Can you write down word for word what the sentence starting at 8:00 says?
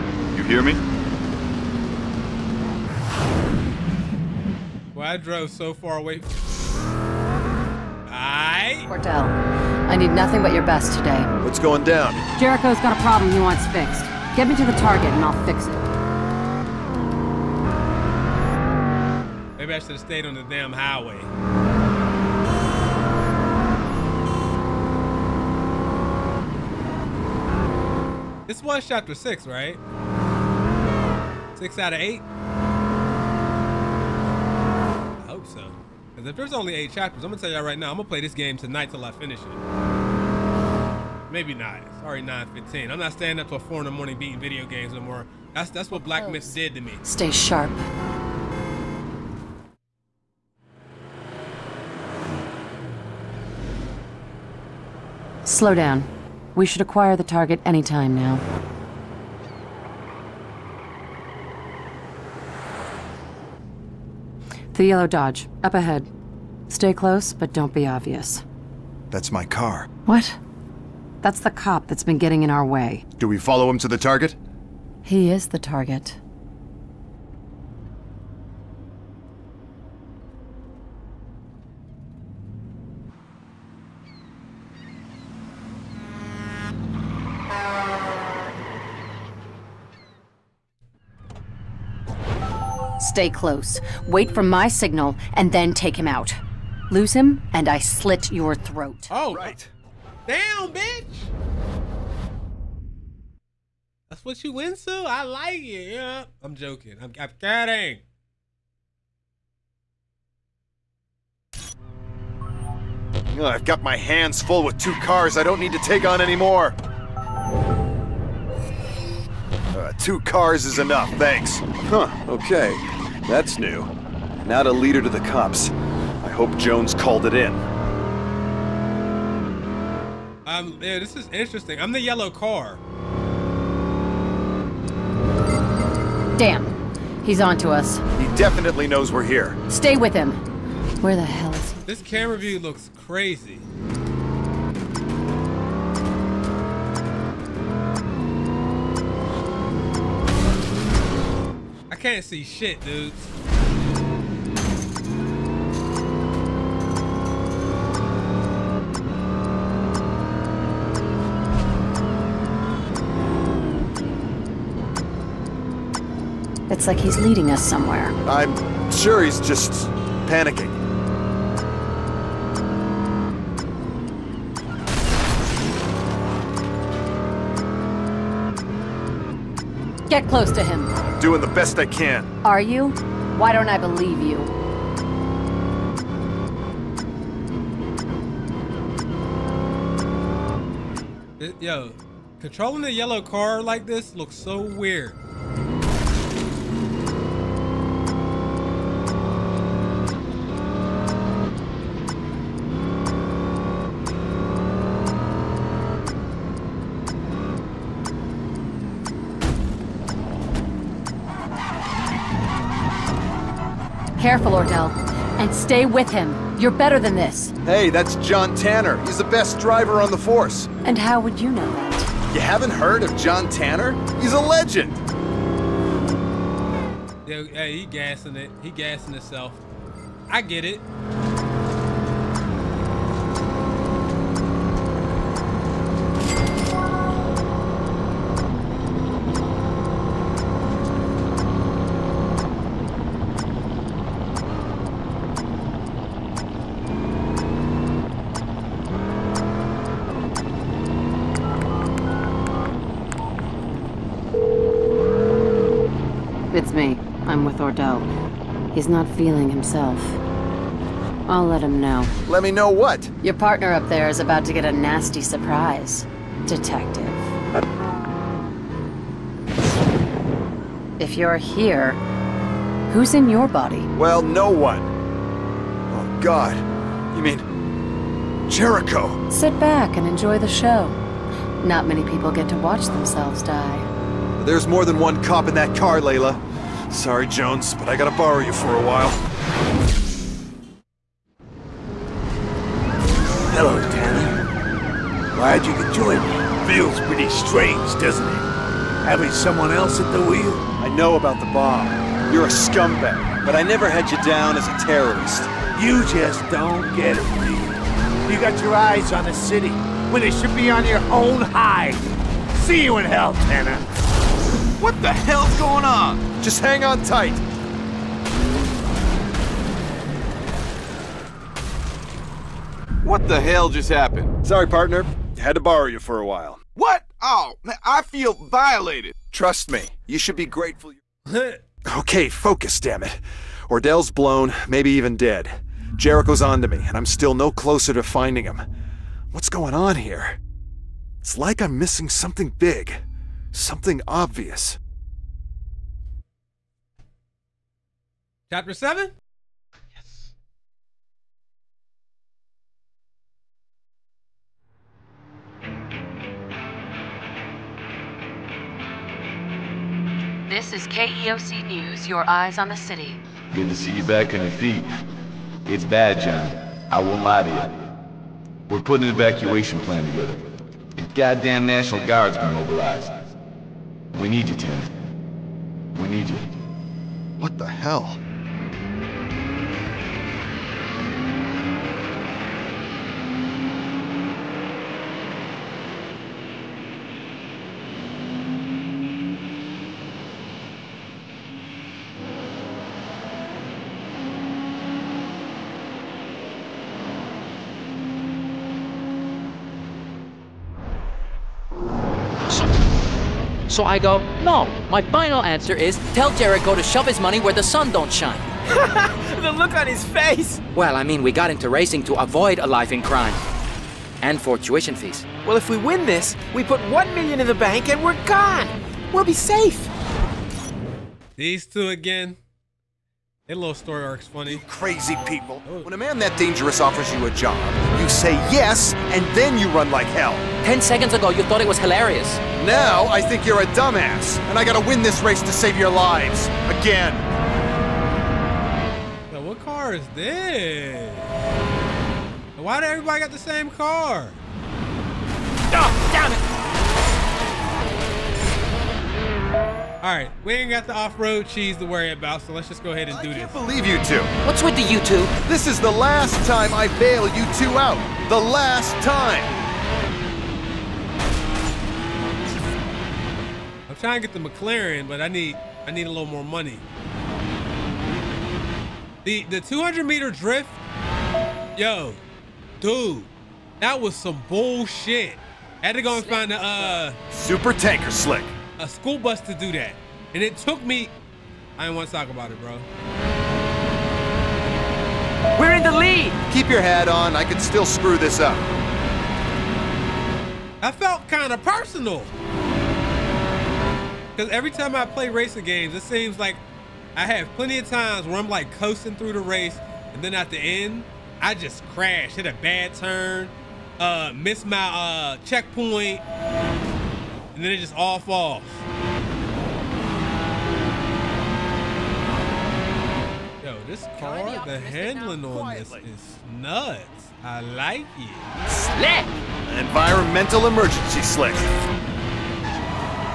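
And it took me, I didn't want to talk about it, bro.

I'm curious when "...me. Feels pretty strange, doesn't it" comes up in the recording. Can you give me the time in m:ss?
4:56.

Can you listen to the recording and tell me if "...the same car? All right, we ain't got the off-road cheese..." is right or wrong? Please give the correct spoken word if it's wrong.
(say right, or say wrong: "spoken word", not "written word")
right.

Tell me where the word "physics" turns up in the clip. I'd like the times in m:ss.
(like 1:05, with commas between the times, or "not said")
not said.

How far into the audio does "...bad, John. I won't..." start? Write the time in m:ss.
6:05.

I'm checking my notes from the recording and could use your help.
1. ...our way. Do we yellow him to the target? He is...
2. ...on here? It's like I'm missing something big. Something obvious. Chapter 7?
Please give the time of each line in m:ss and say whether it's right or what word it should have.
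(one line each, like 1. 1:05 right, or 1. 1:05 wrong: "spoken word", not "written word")
1. 1:12 wrong: "follow", not "yellow"
2. 5:39 right.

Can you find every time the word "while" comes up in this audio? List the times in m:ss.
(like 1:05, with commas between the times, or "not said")
4:48, 5:26.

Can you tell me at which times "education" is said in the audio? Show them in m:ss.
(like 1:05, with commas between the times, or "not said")
not said.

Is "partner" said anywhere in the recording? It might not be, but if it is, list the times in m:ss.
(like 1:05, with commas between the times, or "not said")
4:23, 5:24.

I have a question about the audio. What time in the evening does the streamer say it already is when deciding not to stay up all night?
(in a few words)
9:15.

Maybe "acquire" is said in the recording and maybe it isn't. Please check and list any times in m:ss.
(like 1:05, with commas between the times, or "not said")
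0:56.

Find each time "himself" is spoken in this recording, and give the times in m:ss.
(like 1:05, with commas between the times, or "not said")
3:49, 4:19.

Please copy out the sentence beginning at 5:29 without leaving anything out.
Trust me, you should be grateful.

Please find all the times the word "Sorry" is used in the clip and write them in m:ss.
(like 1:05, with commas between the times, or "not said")
4:46, 5:24.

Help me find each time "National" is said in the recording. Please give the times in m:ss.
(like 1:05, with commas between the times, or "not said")
6:11.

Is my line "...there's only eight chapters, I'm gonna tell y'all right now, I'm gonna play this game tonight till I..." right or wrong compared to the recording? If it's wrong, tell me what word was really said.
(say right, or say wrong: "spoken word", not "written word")
right.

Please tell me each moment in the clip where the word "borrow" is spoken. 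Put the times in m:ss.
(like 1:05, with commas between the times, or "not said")
4:48, 5:25.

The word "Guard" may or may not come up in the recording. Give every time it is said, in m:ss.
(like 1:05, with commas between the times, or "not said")
6:12.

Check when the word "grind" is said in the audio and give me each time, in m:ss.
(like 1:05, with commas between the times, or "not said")
not said.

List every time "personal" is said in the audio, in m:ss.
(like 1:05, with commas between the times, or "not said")
8:11.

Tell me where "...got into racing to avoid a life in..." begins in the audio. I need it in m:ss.
6:51.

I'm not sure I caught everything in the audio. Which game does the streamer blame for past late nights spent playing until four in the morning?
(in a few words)
Black Myth.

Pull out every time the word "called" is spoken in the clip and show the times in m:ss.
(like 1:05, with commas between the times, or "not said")
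2:06.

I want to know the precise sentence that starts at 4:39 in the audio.
Sit back and enjoy the show.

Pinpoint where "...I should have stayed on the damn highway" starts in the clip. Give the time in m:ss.
0:19.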